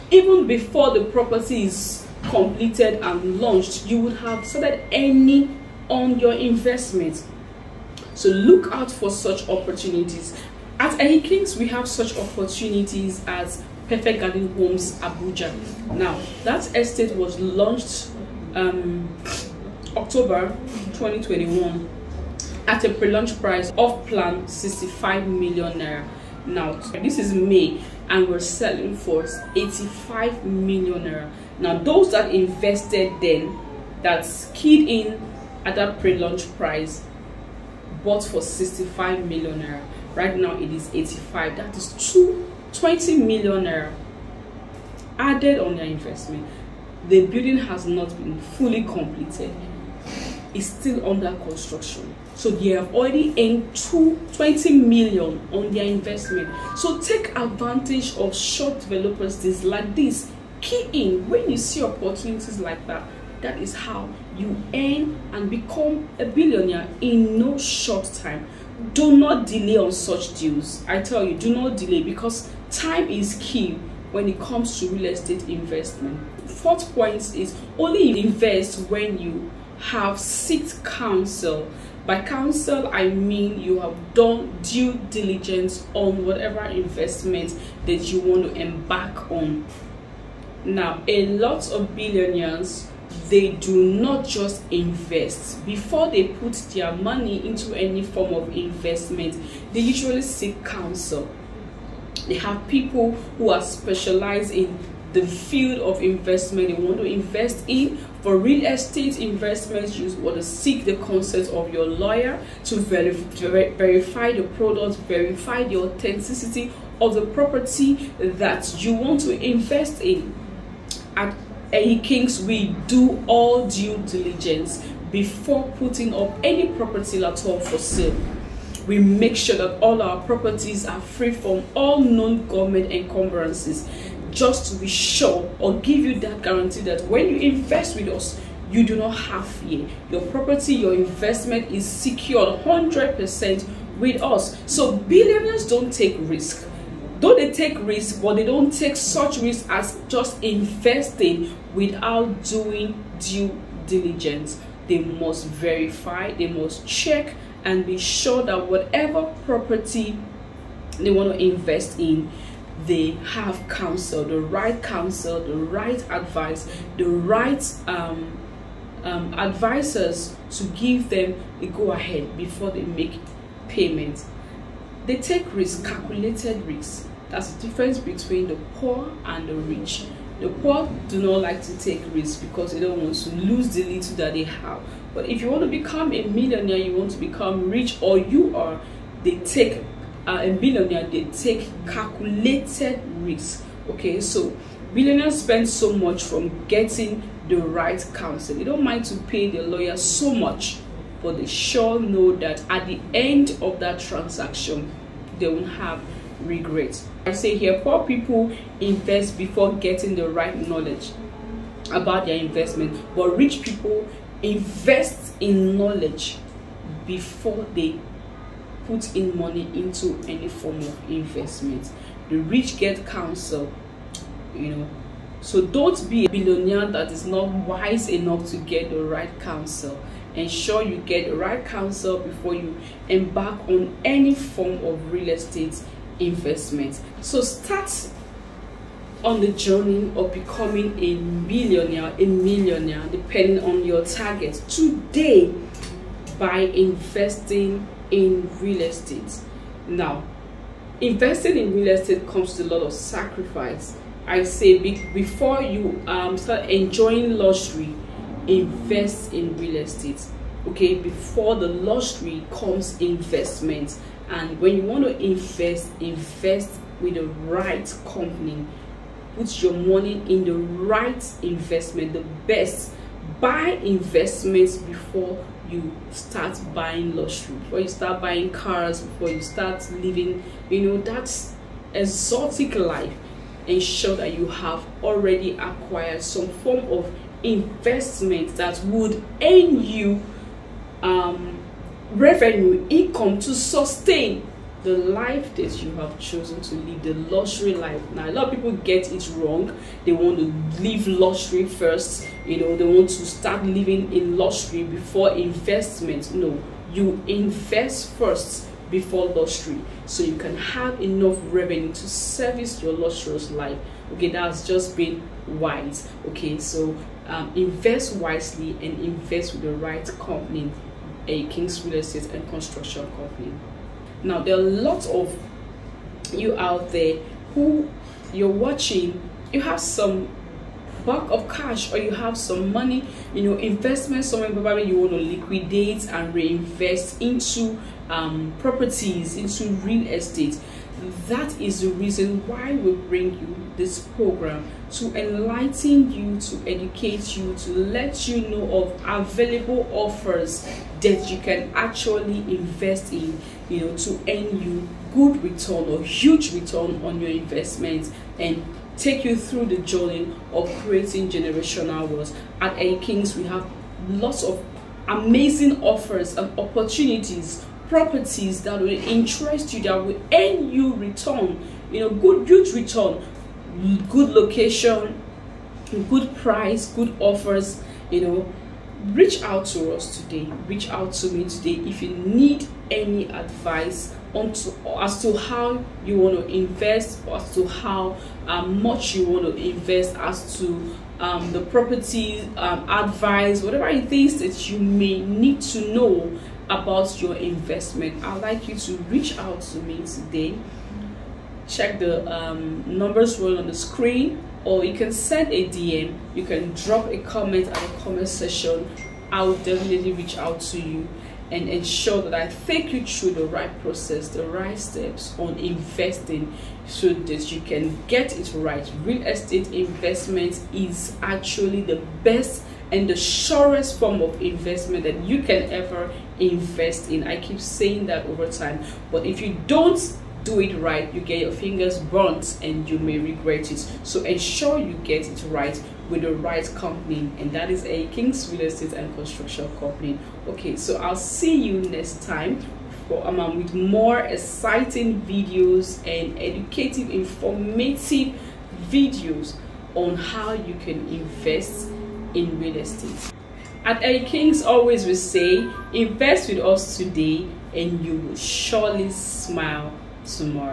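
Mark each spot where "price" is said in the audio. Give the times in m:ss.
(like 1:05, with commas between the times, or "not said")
0:23, 0:36, 6:16.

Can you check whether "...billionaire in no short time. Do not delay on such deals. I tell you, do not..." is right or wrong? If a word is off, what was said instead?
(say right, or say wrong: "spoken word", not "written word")
right.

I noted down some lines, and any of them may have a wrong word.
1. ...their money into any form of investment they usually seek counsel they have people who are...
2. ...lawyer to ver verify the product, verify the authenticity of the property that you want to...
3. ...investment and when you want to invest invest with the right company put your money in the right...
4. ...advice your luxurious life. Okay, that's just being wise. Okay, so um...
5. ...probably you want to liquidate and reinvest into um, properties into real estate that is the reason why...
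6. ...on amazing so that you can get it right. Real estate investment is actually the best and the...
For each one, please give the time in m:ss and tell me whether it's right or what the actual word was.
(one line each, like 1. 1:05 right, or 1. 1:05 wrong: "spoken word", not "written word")
1. 1:36 right
2. 1:51 right
3. 4:23 right
4. 5:12 wrong: "service", not "advice"
5. 5:34 right
6. 6:55 wrong: "investing", not "amazing".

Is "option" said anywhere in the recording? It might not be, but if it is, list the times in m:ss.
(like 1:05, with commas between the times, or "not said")
not said.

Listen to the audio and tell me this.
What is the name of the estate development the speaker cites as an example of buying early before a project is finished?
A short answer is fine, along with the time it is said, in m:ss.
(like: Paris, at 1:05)
Perfect Garden Homes Abuja, at 0:13.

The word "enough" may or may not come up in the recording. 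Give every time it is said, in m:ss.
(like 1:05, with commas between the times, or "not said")
3:48, 5:11.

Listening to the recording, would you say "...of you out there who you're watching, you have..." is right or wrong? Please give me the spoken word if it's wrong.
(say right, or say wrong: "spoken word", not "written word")
right.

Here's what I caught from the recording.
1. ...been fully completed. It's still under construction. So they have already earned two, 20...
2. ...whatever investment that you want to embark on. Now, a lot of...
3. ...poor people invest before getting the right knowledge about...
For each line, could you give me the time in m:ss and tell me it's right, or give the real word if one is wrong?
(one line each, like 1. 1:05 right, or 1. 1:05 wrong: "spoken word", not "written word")
1. 0:48 right
2. 1:26 right
3. 3:27 right.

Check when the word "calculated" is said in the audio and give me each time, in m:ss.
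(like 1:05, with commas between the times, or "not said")
2:55, 3:11.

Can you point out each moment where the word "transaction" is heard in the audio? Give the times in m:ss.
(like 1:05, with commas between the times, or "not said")
3:24.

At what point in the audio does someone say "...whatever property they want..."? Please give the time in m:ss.
2:38.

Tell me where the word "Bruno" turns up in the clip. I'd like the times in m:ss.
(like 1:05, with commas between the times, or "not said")
not said.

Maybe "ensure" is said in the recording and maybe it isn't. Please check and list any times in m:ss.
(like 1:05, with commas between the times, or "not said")
3:50, 4:43, 6:51, 7:14.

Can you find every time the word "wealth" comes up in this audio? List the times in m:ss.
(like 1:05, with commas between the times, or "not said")
6:02.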